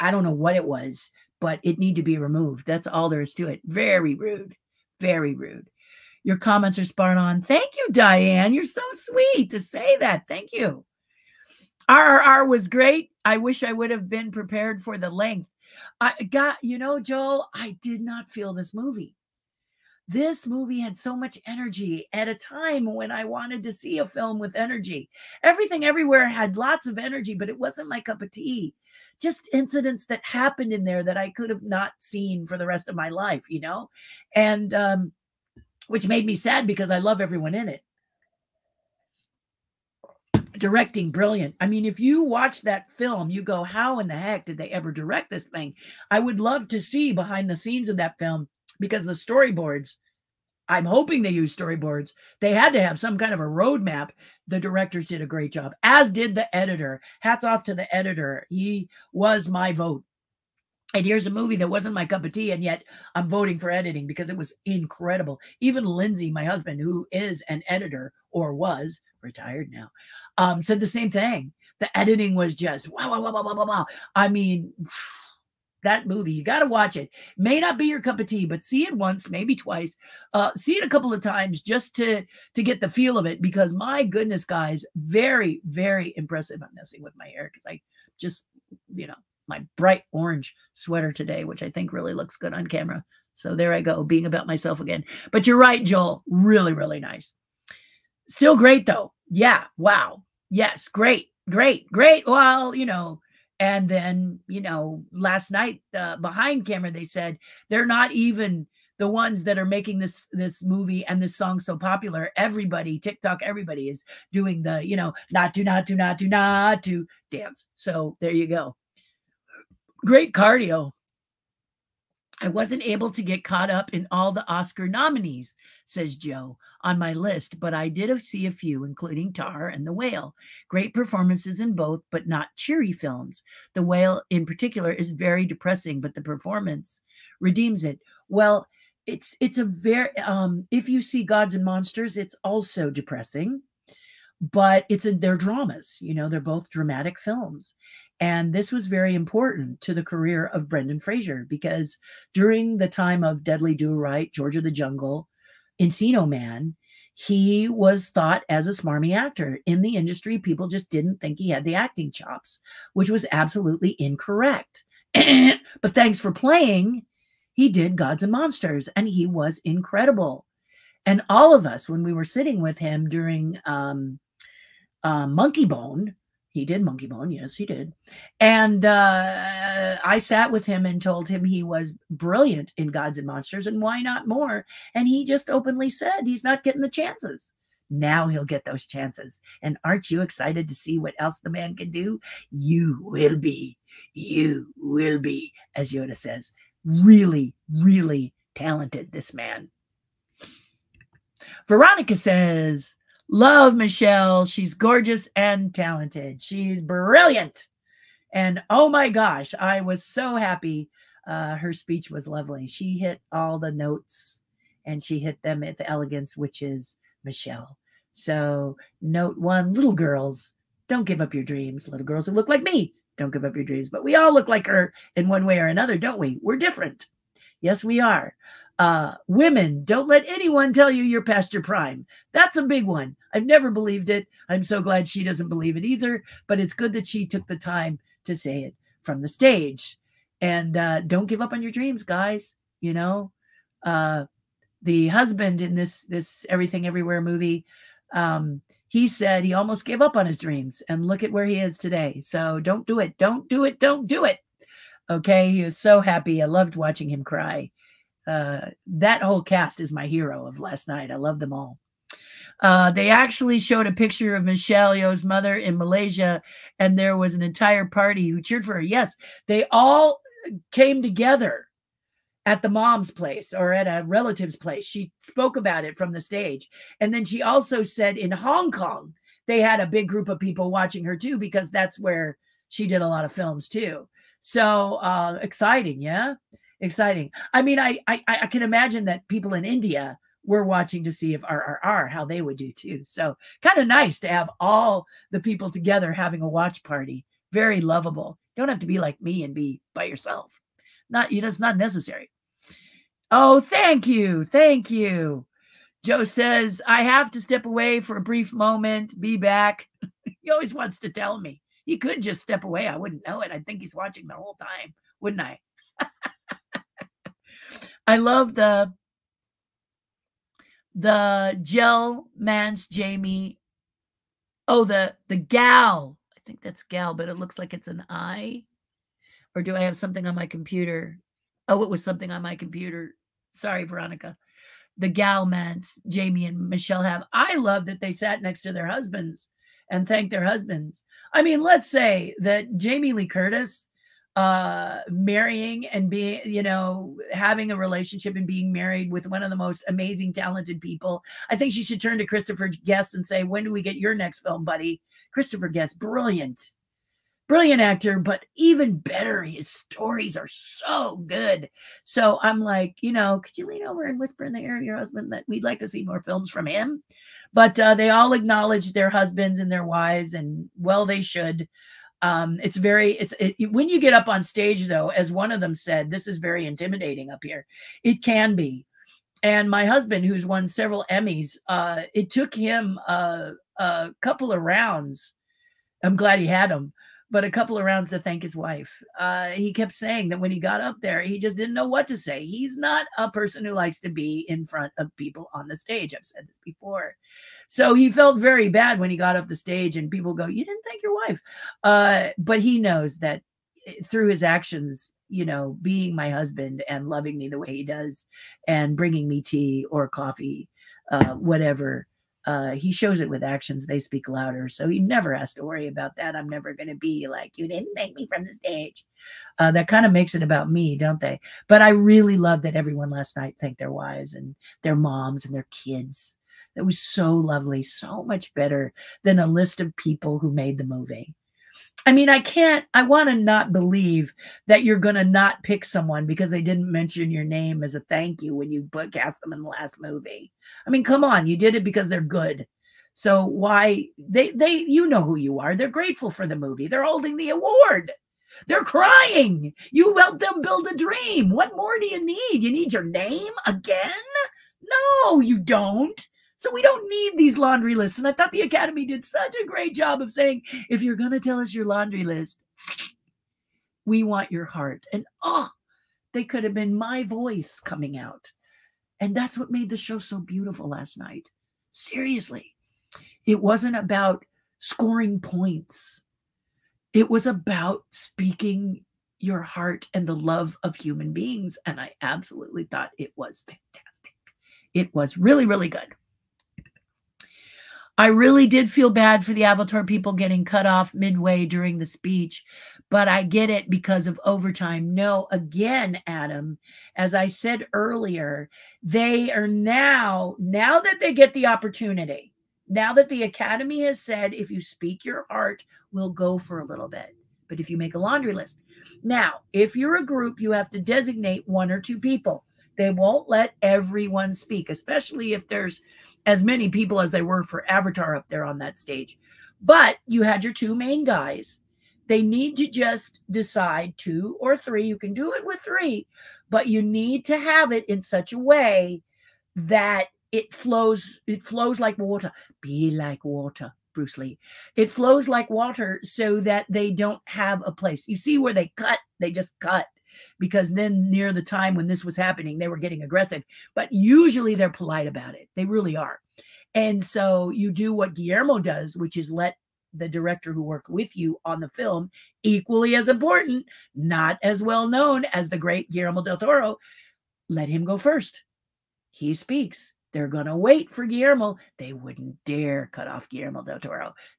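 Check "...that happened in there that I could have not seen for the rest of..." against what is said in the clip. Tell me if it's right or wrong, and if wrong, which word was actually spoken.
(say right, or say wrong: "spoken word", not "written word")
right.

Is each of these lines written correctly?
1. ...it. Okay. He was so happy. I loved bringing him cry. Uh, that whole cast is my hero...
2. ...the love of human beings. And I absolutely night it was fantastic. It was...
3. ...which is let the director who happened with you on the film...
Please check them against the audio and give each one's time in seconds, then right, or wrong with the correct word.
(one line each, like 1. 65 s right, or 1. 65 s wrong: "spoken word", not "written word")
1. 254 s wrong: "watching", not "bringing"
2. 480 s wrong: "thought", not "night"
3. 549 s wrong: "worked", not "happened".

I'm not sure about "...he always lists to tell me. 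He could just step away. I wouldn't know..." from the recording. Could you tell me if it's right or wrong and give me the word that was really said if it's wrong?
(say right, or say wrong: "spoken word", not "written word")
wrong: "wants", not "lists".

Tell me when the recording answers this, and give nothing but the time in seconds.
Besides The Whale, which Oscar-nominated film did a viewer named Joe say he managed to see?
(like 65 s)
129 s.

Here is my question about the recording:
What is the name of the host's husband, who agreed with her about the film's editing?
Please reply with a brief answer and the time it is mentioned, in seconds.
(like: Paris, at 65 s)
Lindsay, at 65 s.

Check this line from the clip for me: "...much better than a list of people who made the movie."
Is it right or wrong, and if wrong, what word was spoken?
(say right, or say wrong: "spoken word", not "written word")
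right.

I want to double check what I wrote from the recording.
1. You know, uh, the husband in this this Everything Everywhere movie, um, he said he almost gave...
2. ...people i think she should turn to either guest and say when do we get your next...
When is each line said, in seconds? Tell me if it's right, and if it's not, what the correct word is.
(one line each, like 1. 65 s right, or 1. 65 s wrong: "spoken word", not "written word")
1. 242 s right
2. 350 s wrong: "christopher", not "either".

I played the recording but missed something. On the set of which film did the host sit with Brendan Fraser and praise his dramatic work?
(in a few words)
Monkeybone.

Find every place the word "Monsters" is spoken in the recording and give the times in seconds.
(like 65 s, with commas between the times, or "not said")
141 s, 168 s, 183 s.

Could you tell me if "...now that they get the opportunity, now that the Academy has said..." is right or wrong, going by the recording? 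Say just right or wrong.
right.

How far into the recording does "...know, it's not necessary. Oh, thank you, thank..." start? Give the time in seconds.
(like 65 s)
301 s.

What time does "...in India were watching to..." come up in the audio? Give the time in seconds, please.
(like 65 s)
289 s.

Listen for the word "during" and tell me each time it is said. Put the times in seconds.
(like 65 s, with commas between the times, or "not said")
152 s, 173 s, 491 s.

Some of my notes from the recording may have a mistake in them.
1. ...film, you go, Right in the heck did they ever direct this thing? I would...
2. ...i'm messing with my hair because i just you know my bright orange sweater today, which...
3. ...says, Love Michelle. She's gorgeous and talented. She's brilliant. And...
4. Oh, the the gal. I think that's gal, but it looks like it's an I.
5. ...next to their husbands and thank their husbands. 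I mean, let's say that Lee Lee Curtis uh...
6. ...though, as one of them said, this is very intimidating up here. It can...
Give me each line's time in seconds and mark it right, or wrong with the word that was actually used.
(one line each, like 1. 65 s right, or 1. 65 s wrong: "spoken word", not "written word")
1. 42 s wrong: "How", not "Right"
2. 86 s right
3. 202 s right
4. 324 s right
5. 338 s wrong: "Jamie", not "Lee"
6. 374 s right.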